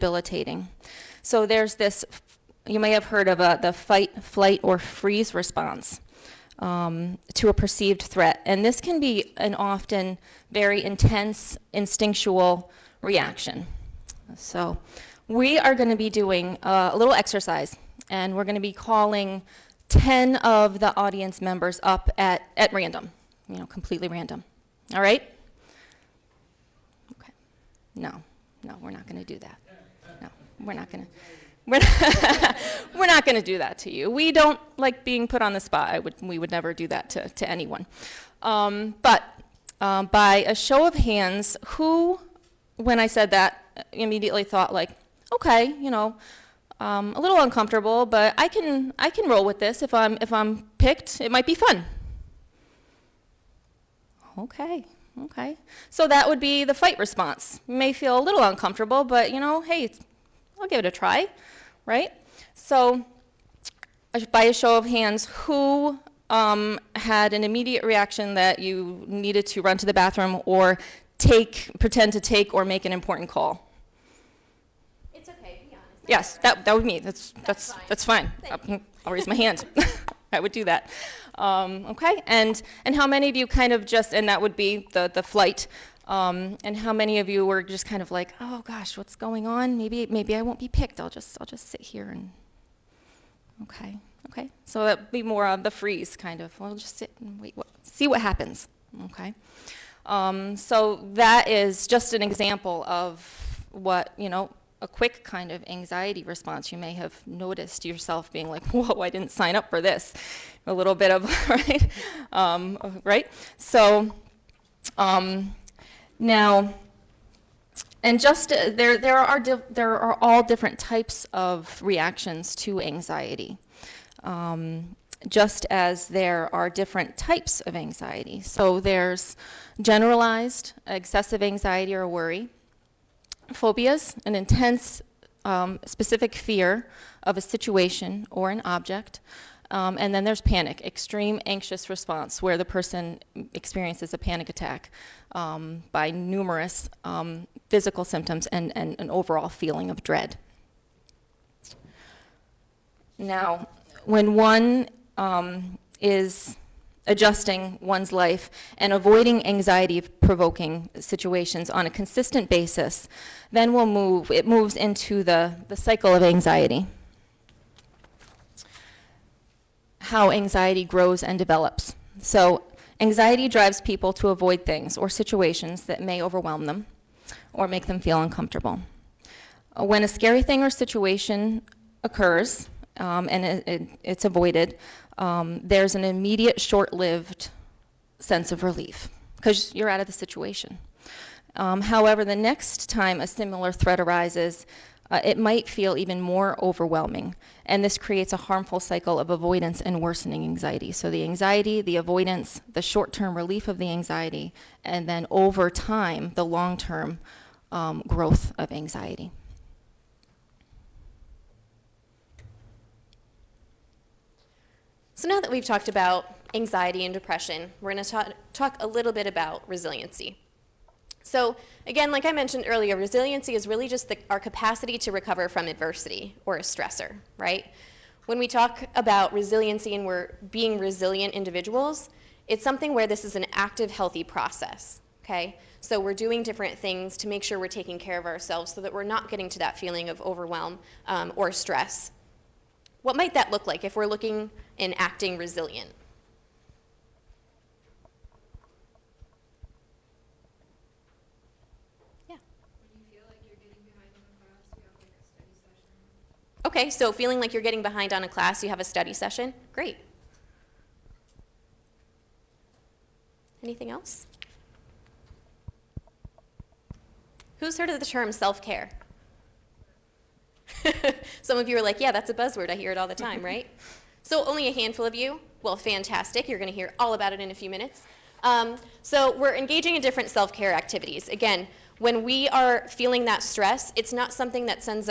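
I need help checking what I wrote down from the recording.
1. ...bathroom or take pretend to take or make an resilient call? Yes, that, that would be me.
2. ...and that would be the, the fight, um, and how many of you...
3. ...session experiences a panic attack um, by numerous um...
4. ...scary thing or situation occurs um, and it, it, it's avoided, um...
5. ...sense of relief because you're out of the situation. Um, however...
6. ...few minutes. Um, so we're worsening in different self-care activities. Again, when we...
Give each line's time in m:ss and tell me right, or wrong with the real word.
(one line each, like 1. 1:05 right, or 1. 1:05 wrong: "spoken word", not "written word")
1. 1:09 wrong: "important", not "resilient"
2. 1:24 wrong: "flight", not "fight"
3. 2:22 wrong: "person", not "session"
4. 3:00 right
5. 3:08 right
6. 4:37 wrong: "engaging", not "worsening".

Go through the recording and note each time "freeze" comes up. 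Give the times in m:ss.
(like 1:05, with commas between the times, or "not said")
0:04, 1:35.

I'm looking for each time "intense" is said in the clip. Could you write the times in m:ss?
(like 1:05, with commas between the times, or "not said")
0:10, 2:14.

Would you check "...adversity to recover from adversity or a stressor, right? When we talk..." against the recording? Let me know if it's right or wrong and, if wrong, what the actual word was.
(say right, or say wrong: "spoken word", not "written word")
wrong: "capacity", not "adversity".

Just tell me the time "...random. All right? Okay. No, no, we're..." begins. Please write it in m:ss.
0:24.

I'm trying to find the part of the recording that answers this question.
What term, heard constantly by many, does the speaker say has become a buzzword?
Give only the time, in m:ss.
4:28.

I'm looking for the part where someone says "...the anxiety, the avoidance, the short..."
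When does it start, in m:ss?
3:21.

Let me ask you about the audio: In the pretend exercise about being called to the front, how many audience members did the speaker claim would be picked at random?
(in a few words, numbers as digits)
10.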